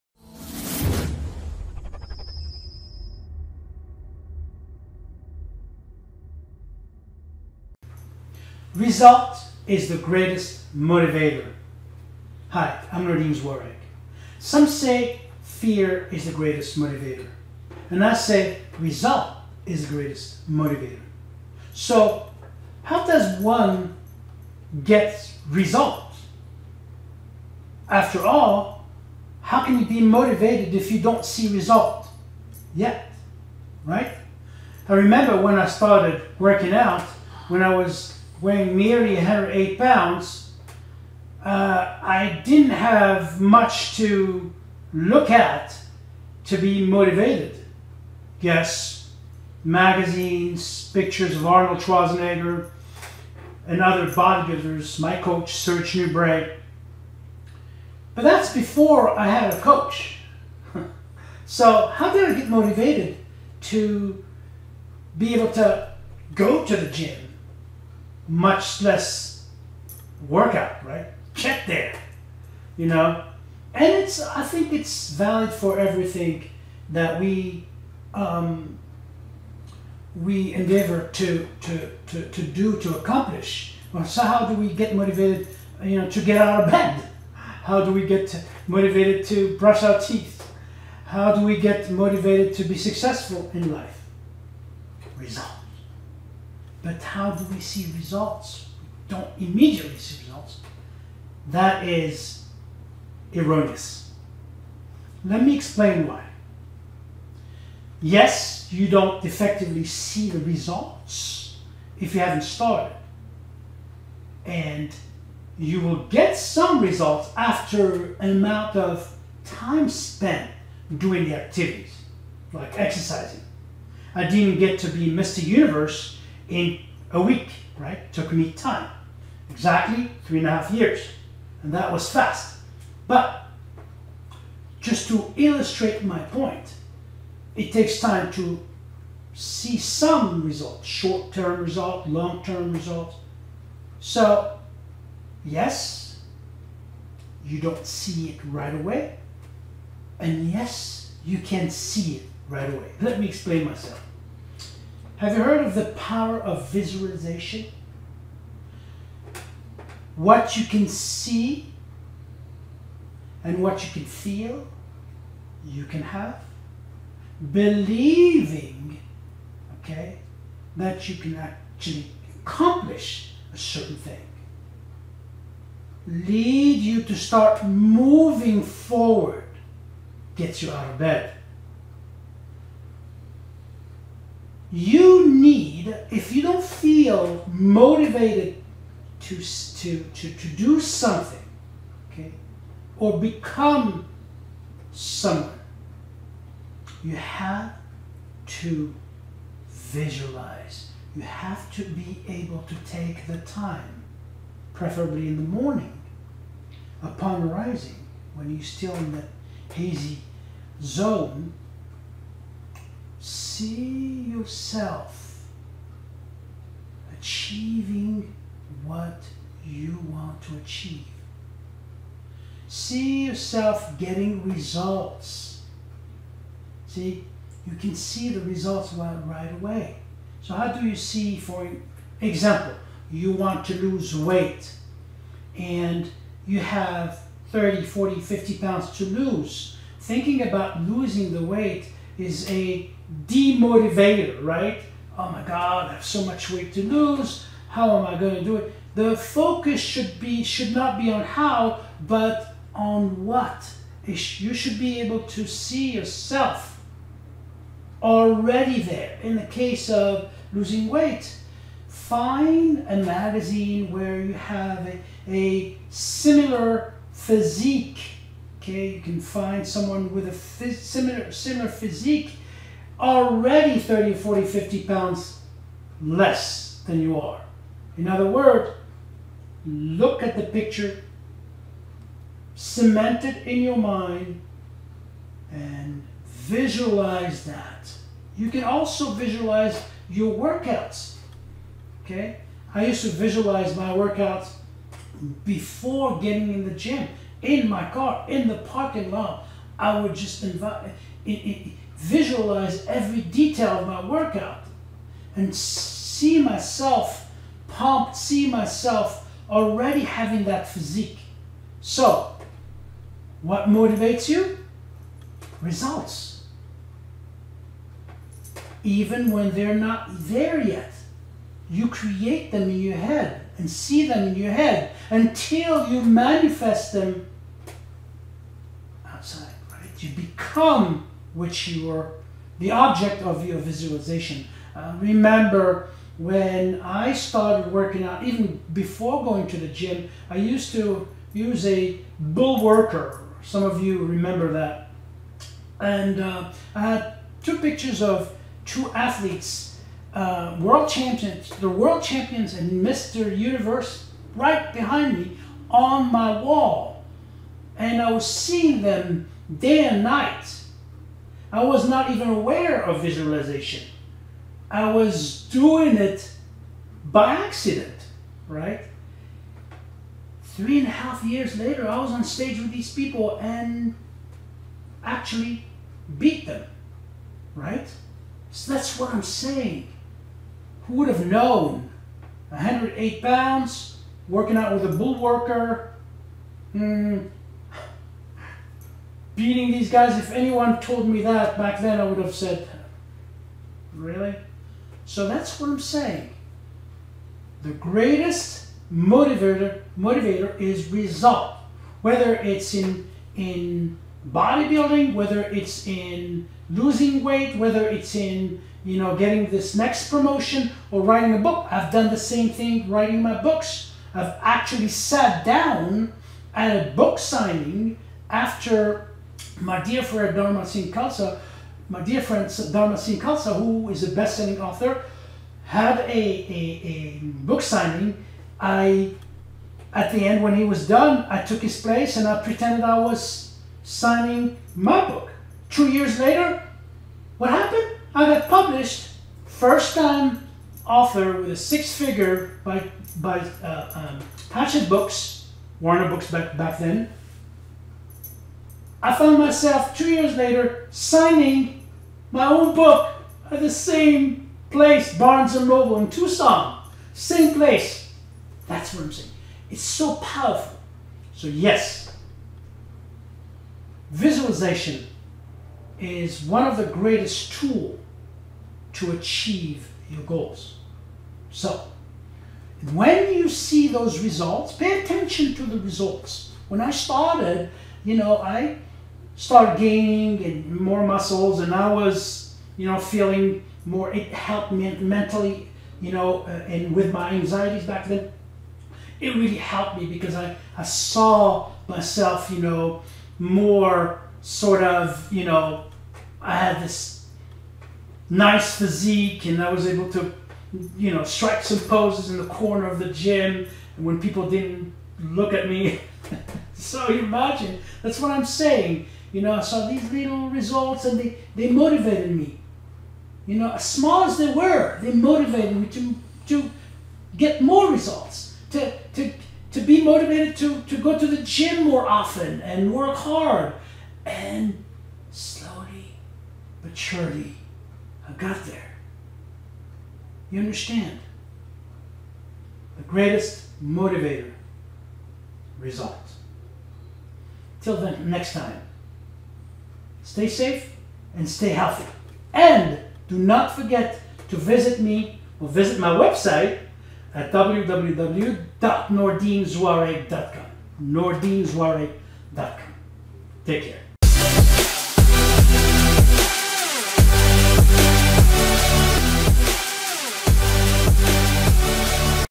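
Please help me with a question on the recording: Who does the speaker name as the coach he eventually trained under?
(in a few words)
Serge Nubret.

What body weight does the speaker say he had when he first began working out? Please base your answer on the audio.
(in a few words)
108 pounds.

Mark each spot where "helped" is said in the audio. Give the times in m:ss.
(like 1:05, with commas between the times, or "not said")
8:04, 8:09.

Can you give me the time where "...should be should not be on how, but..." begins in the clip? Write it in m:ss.
4:09.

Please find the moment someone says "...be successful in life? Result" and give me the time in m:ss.
1:32.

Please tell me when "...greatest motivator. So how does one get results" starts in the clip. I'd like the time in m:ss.
0:19.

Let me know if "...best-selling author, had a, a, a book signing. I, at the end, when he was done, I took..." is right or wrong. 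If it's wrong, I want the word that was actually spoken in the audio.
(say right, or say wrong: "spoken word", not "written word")
right.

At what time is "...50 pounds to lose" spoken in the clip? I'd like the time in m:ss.
3:58.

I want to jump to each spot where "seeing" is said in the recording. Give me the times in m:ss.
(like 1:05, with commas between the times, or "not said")
5:58.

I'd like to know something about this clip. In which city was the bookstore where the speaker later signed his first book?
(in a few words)
Tucson.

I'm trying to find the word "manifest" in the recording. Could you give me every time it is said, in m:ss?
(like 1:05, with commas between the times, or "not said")
5:26.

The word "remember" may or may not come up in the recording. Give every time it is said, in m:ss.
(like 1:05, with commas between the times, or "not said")
0:34, 5:34, 5:44.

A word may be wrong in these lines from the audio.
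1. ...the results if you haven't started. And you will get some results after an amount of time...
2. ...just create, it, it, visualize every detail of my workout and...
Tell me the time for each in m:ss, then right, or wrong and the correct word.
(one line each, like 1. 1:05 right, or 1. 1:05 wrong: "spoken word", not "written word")
1. 1:50 right
2. 5:00 wrong: "invite", not "create".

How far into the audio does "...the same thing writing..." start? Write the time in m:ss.
6:52.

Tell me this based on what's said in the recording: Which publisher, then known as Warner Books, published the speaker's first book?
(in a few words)
Hachette Books.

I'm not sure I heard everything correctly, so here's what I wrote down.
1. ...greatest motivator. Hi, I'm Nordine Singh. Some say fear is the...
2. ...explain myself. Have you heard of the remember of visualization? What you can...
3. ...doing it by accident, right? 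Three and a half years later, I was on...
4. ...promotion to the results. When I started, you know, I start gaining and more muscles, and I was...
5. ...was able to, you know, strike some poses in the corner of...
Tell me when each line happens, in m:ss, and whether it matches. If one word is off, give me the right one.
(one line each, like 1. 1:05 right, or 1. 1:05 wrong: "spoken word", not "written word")
1. 0:09 wrong: "Zouareg", not "Singh"
2. 2:33 wrong: "power", not "remember"
3. 6:05 right
4. 7:55 wrong: "attention", not "promotion"
5. 8:19 right.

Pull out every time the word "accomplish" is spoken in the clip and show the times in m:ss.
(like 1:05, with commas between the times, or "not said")
1:22, 2:52.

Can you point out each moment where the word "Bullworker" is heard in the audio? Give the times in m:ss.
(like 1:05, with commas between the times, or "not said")
5:42, 6:24.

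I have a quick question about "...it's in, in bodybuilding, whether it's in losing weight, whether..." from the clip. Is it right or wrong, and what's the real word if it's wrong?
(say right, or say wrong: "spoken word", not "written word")
right.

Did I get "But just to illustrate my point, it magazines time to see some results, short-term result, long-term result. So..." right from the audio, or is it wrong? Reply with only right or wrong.
wrong.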